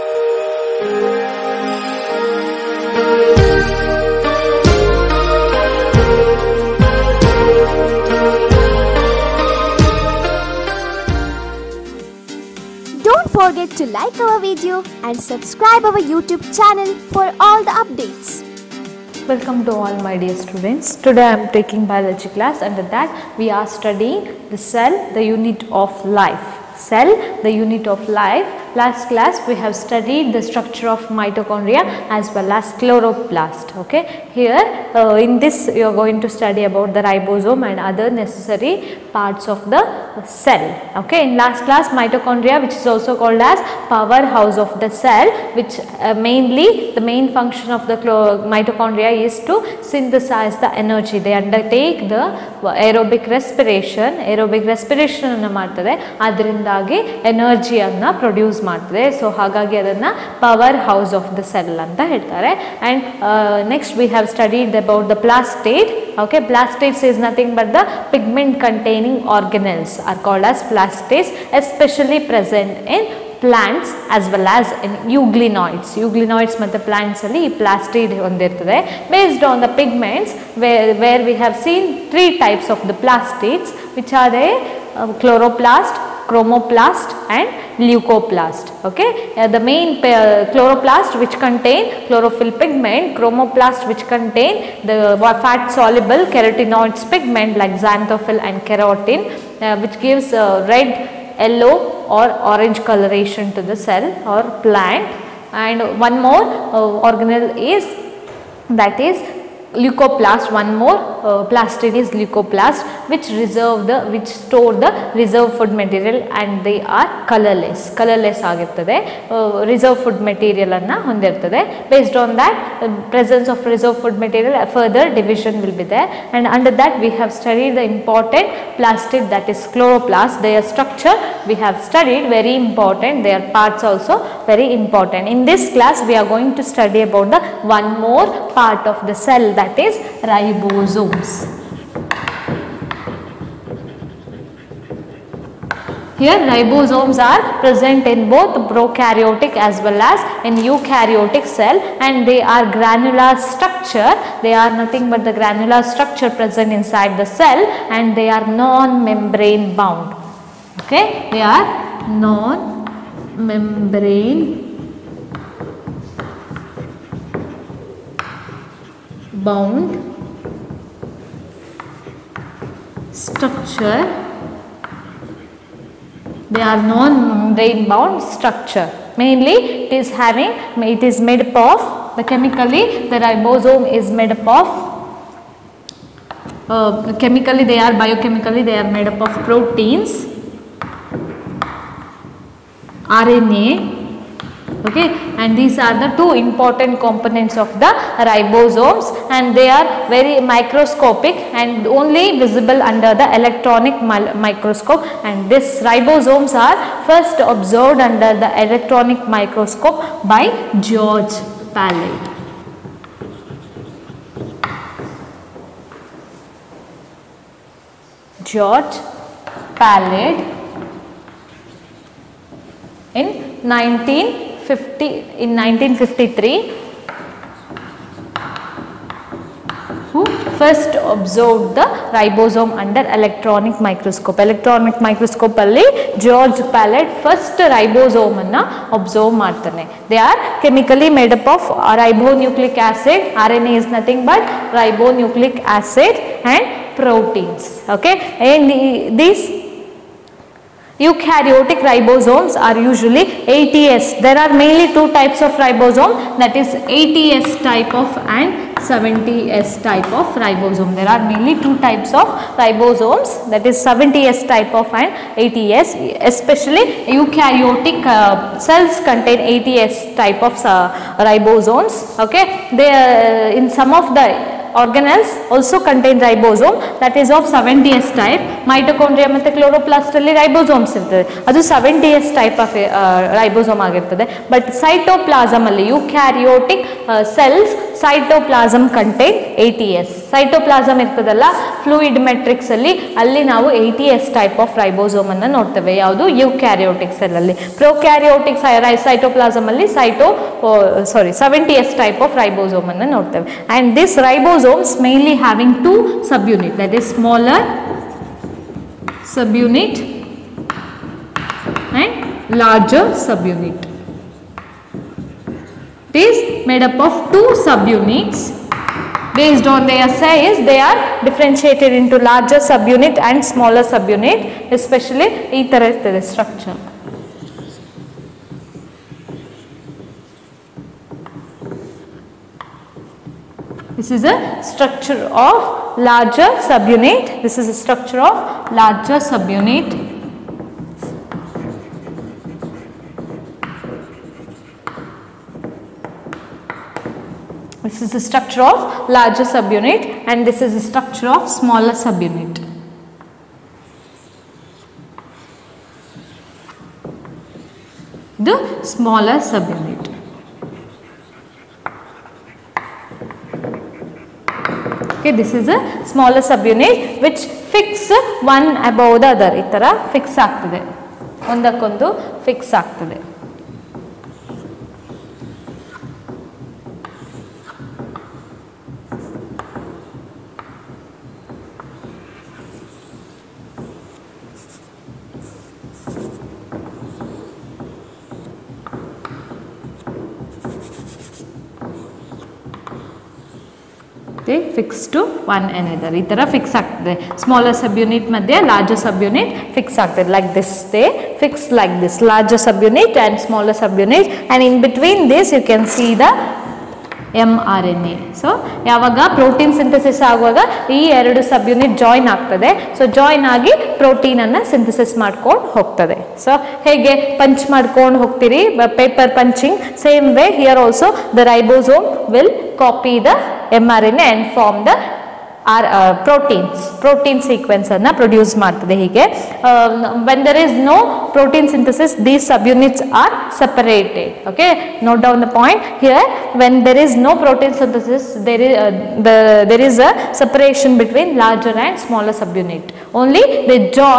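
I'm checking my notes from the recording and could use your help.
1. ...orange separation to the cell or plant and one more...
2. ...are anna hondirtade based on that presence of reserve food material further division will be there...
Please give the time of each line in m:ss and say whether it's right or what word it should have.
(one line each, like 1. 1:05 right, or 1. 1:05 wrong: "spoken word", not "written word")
1. 1:42 wrong: "coloration", not "separation"
2. 2:00 right.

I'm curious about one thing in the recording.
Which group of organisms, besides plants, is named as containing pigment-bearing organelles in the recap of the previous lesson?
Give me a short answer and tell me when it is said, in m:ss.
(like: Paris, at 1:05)
Euglenoids, at 1:13.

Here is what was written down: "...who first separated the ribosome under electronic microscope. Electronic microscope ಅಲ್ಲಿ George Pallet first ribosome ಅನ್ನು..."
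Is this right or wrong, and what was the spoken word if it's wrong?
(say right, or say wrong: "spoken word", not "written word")
wrong: "observed", not "separated".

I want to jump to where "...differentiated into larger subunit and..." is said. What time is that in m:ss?
5:21.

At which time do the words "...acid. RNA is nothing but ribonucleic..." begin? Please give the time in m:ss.
4:02.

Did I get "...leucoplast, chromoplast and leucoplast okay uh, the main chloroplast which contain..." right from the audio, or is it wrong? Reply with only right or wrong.
wrong.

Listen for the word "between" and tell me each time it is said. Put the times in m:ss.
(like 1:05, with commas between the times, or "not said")
6:44, 7:21.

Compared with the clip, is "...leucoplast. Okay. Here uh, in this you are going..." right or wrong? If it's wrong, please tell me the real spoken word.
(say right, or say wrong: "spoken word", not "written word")
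wrong: "chloroplast", not "leucoplast".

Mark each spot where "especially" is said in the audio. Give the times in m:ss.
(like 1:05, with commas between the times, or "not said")
4:26, 5:24.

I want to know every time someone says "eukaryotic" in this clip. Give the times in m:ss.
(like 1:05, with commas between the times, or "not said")
2:30, 4:10, 4:27.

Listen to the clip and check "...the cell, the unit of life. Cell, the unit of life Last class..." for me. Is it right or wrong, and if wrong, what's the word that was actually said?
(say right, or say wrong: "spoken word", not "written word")
right.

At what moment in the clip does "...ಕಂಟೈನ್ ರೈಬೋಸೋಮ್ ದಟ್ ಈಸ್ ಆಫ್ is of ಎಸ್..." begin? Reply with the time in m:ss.
4:35.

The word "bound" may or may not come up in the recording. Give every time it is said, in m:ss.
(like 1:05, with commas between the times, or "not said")
2:39, 2:49, 2:57.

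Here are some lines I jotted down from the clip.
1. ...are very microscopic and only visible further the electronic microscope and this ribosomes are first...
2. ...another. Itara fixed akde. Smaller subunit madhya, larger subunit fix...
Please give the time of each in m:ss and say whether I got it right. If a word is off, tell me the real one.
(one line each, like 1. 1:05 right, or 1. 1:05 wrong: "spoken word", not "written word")
1. 3:19 wrong: "under", not "further"
2. 6:35 right.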